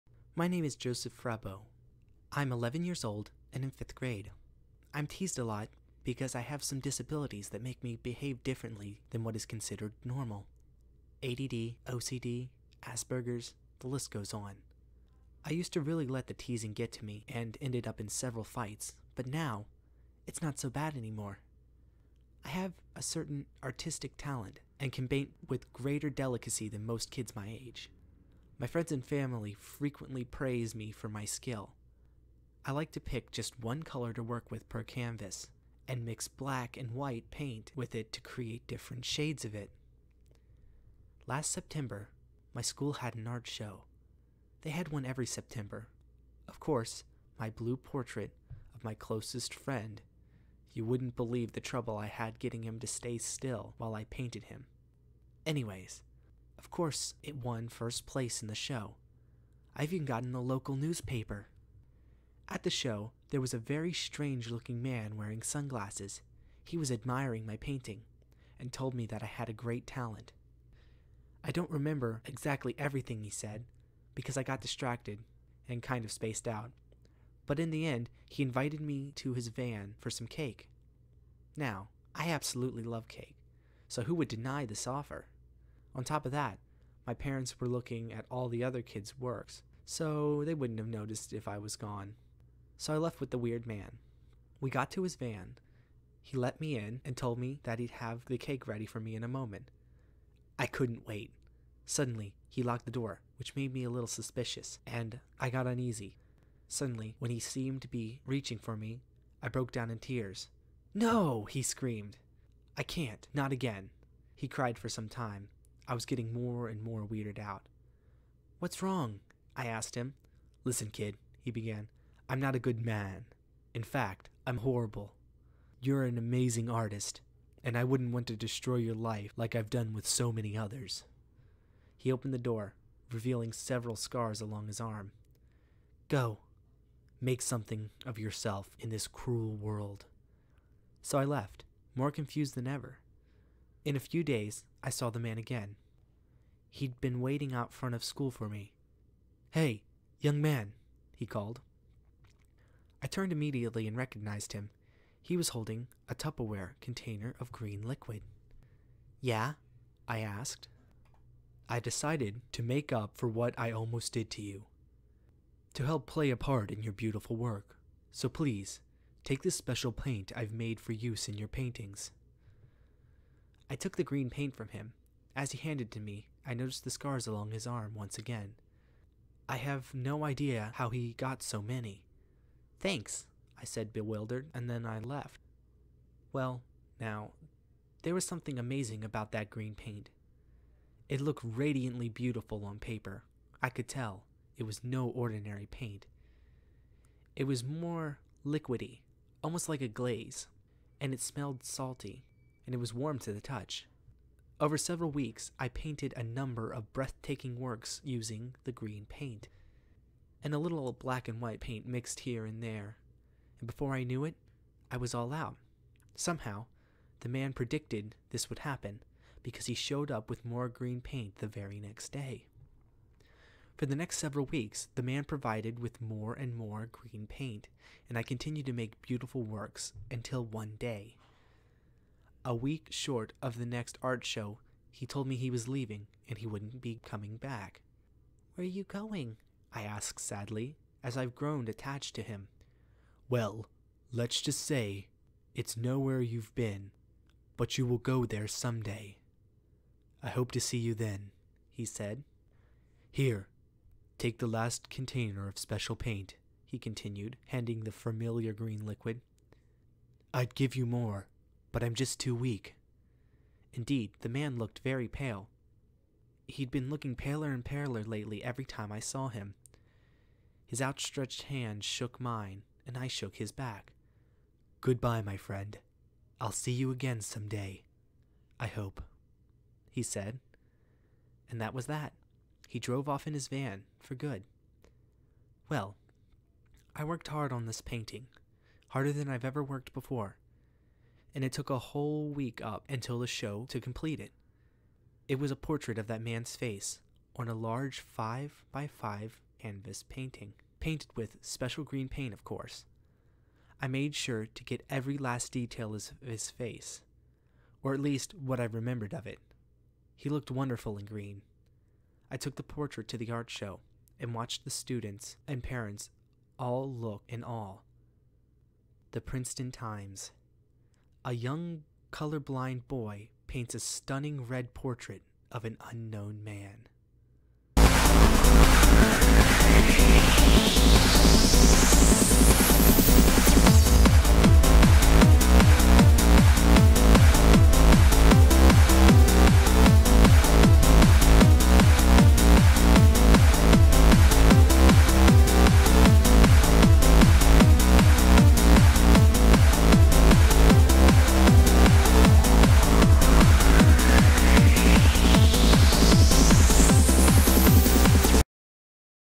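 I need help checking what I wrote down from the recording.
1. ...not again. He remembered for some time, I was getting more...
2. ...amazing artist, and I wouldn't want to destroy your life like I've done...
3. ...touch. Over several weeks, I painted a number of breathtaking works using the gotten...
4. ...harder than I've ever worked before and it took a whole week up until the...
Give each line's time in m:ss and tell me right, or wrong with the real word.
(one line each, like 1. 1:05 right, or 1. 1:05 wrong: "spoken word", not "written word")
1. 1:53 wrong: "cried", not "remembered"
2. 2:06 right
3. 3:23 wrong: "green", not "gotten"
4. 4:48 right.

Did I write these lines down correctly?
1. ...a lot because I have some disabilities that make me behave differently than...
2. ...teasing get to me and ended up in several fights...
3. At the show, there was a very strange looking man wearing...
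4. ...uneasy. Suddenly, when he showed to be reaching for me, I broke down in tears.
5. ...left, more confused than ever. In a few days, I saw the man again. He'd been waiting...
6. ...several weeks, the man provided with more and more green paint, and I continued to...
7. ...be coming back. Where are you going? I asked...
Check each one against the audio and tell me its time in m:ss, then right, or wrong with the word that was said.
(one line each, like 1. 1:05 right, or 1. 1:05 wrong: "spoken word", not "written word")
1. 0:05 right
2. 0:16 right
3. 1:02 right
4. 1:45 wrong: "seemed", not "showed"
5. 2:21 right
6. 3:44 right
7. 3:56 right.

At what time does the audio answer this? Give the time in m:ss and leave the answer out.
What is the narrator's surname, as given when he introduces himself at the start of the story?
0:00.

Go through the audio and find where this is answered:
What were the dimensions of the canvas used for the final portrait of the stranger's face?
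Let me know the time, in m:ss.
4:57.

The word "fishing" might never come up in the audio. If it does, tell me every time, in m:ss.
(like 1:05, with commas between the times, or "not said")
not said.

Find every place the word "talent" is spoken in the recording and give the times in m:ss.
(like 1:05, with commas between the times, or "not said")
0:24, 1:09.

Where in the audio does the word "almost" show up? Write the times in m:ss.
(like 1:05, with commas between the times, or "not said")
2:43, 3:19.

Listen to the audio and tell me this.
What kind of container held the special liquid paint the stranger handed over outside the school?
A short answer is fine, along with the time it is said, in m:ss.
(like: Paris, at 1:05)
Tupperware, at 2:36.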